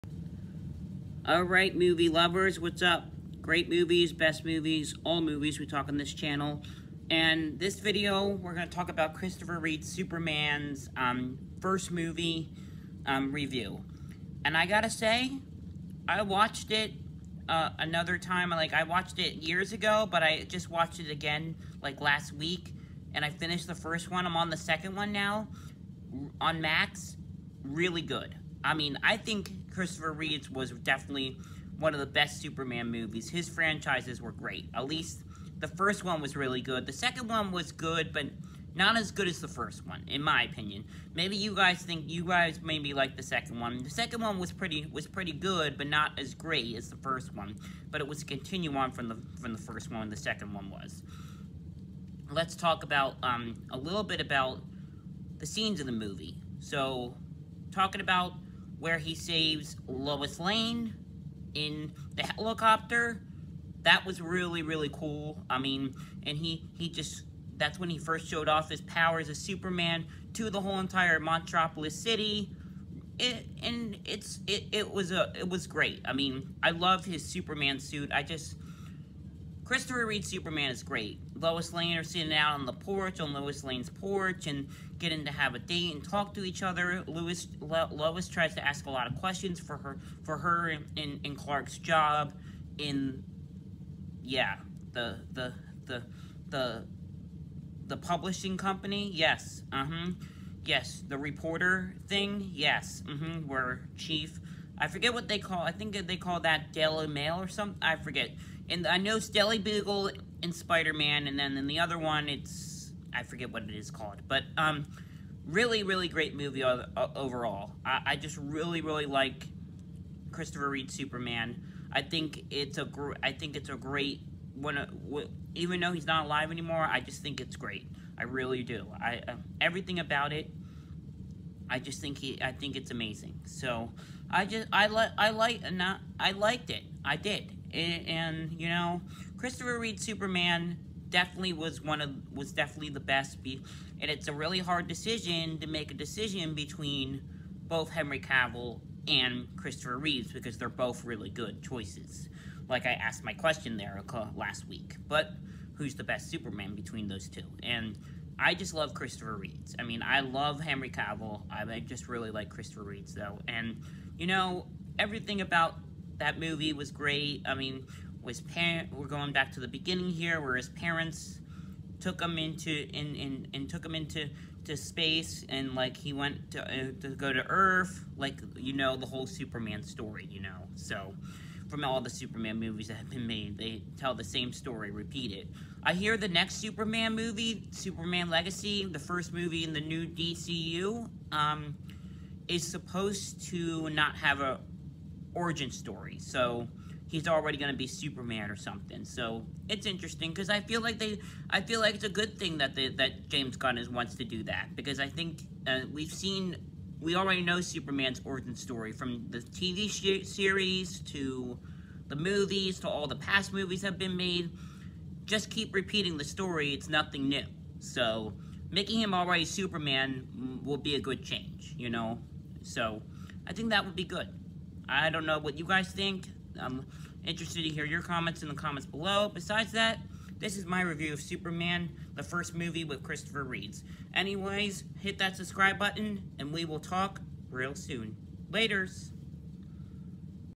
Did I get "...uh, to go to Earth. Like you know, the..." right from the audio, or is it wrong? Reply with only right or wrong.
right.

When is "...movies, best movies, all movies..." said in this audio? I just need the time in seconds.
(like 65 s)
3 s.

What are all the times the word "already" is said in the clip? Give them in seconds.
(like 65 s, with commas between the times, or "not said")
197 s, 207 s, 219 s.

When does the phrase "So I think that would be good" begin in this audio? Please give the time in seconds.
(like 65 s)
222 s.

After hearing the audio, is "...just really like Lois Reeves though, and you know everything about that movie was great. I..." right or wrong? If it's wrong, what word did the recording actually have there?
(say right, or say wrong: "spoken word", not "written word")
wrong: "Christopher", not "Lois".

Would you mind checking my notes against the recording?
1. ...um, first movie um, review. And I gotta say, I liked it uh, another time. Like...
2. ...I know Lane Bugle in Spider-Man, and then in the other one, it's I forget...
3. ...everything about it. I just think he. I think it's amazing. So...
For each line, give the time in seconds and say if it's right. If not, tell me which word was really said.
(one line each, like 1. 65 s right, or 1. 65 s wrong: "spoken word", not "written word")
1. 10 s wrong: "watched", not "liked"
2. 108 s wrong: "Daily", not "Lane"
3. 129 s right.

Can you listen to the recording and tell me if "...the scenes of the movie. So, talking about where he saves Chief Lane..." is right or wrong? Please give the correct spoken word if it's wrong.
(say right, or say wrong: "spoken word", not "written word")
wrong: "Lois", not "Chief".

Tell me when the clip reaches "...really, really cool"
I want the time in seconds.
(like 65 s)
64 s.